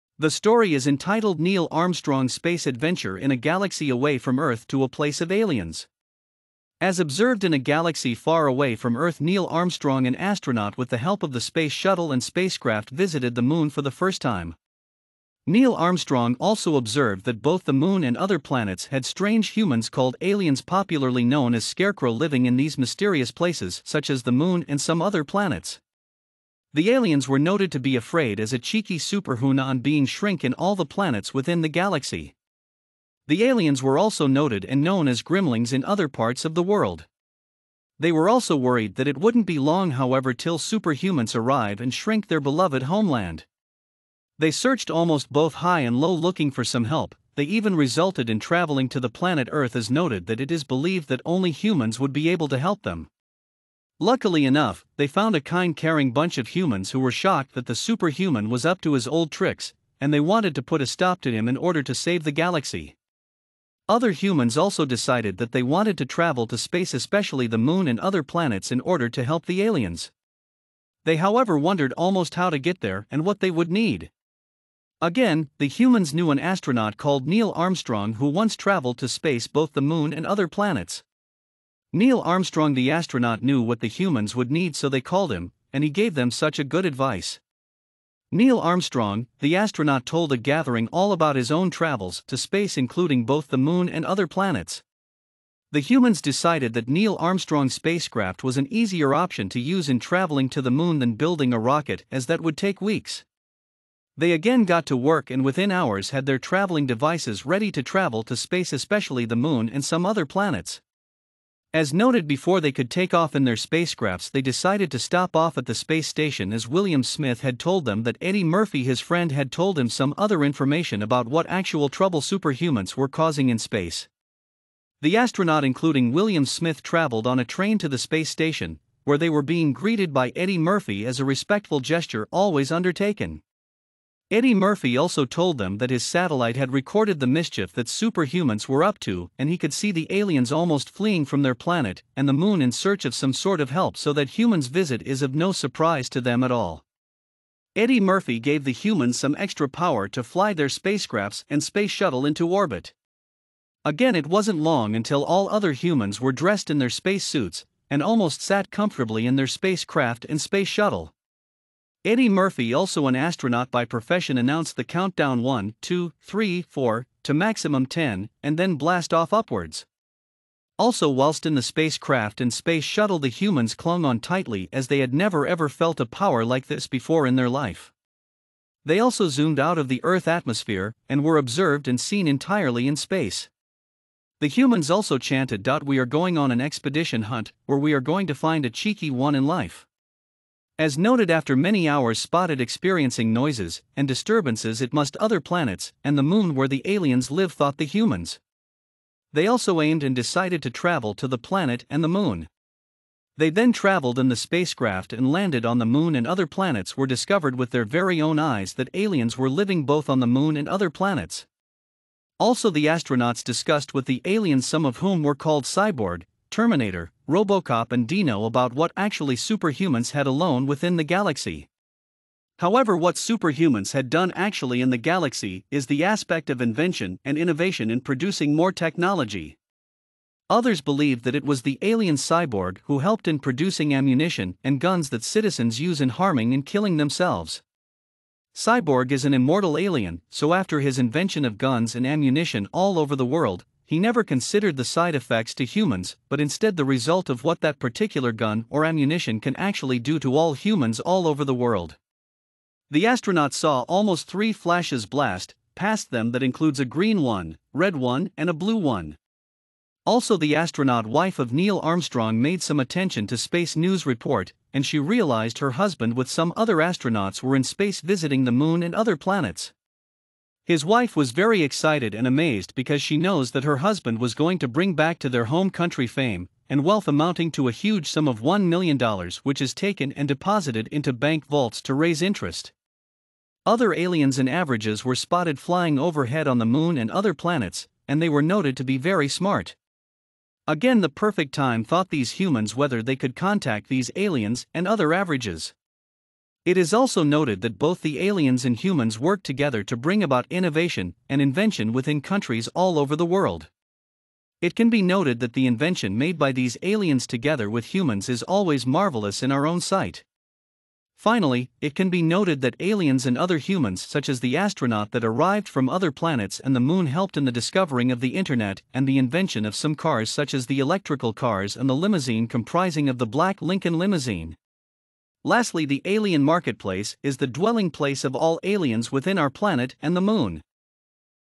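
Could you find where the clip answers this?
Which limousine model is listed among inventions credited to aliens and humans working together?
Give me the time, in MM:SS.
05:23.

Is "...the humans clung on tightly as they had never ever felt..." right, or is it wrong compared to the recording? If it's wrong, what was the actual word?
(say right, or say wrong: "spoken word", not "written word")
right.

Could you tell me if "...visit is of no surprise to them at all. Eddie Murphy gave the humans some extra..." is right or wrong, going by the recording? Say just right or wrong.
right.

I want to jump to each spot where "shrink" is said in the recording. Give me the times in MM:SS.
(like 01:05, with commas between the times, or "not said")
00:30, 00:41.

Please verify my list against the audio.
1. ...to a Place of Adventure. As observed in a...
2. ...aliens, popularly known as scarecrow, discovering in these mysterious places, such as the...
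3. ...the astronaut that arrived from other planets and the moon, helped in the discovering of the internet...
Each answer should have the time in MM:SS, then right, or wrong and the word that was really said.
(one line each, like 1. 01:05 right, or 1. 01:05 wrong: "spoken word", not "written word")
1. 00:04 wrong: "Aliens", not "Adventure"
2. 00:20 wrong: "living", not "discovering"
3. 05:14 right.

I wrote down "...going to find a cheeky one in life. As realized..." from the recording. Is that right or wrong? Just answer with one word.
wrong.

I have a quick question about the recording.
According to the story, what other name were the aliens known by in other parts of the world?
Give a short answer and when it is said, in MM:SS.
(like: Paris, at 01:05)
grimlings, at 00:35.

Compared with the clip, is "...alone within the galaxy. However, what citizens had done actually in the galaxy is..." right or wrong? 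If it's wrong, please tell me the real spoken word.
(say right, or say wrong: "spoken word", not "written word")
wrong: "superhumans", not "citizens".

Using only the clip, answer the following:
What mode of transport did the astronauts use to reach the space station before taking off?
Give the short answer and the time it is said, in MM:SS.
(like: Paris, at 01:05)
a train, at 02:07.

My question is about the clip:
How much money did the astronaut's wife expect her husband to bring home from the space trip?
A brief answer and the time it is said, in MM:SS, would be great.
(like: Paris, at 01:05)
$1 million, at 04:38.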